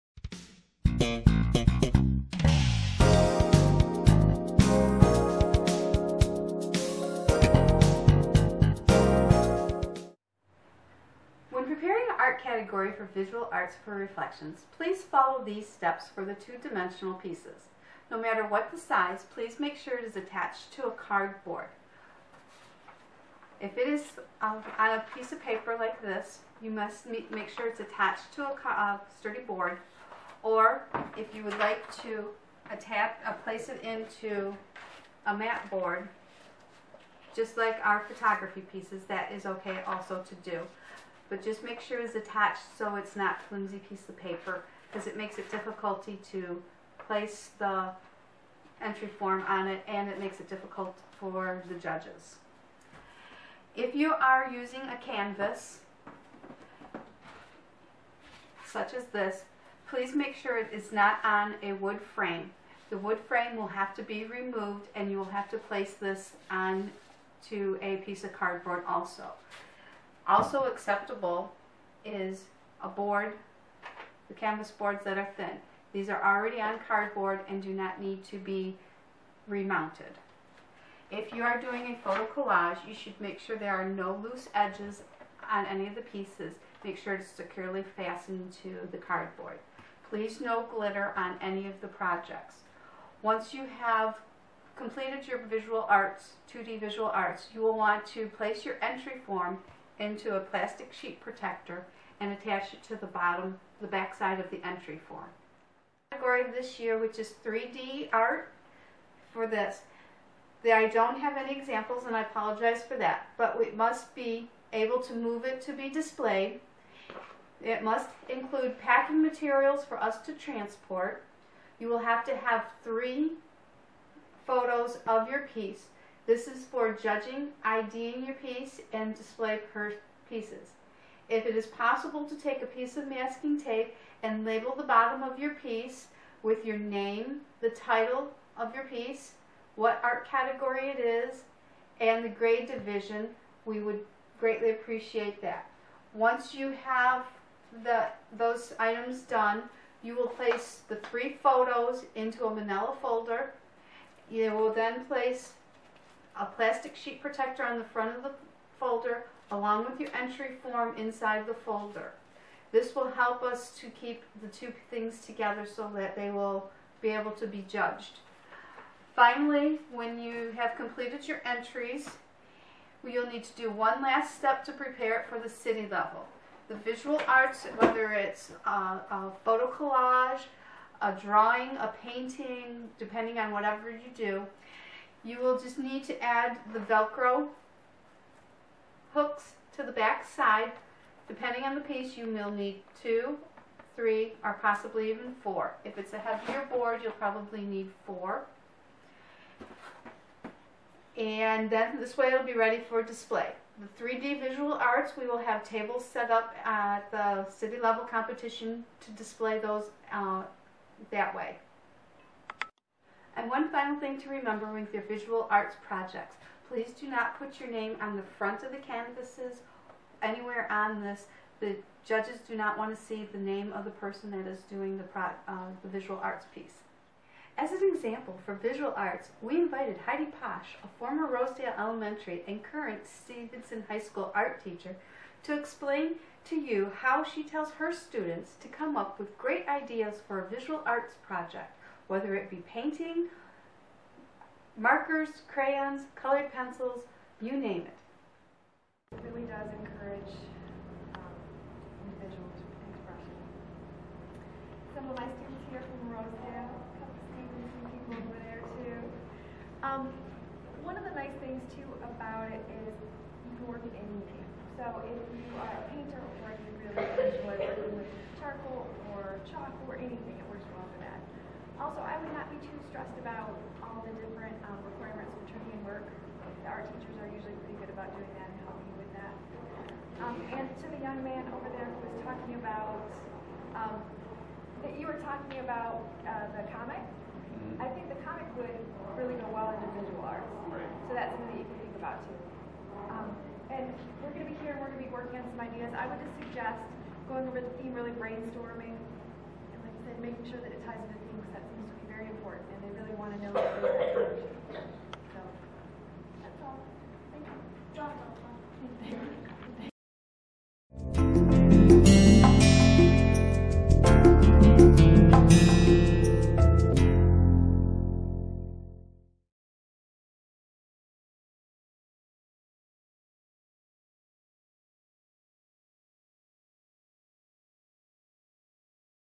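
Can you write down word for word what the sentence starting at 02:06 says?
This is for judging, IDing your piece, and display per pieces.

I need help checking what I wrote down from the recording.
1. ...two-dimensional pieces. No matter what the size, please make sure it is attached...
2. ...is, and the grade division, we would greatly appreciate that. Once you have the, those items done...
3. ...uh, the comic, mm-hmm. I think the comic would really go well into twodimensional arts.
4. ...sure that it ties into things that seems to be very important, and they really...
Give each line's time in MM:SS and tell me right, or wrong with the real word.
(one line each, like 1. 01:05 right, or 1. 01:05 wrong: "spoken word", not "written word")
1. 00:16 right
2. 02:20 right
3. 04:46 wrong: "visual", not "twodimensional"
4. 05:00 right.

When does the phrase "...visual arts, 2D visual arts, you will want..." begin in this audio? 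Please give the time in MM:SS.
01:35.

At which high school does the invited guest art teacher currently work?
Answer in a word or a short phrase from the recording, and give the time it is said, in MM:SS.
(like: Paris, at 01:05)
Stevenson High School, at 03:53.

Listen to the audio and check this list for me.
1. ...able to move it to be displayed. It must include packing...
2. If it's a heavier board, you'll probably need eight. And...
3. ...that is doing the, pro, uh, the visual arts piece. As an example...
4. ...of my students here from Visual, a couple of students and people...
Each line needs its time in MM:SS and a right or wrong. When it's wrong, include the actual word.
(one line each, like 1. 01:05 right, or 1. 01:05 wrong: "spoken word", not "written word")
1. 01:54 right
2. 03:15 wrong: "four", not "eight"
3. 03:44 right
4. 04:15 wrong: "Rosedale", not "Visual".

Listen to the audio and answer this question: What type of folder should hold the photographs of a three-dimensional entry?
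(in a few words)
manila folder.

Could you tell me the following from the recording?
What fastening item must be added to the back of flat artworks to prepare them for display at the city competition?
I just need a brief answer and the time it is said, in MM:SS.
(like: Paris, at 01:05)
Velcro hooks, at 03:06.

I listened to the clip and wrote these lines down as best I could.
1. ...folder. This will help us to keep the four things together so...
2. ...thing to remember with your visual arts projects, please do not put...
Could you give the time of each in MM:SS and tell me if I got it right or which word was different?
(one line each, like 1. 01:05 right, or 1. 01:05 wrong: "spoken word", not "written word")
1. 02:41 wrong: "two", not "four"
2. 03:33 right.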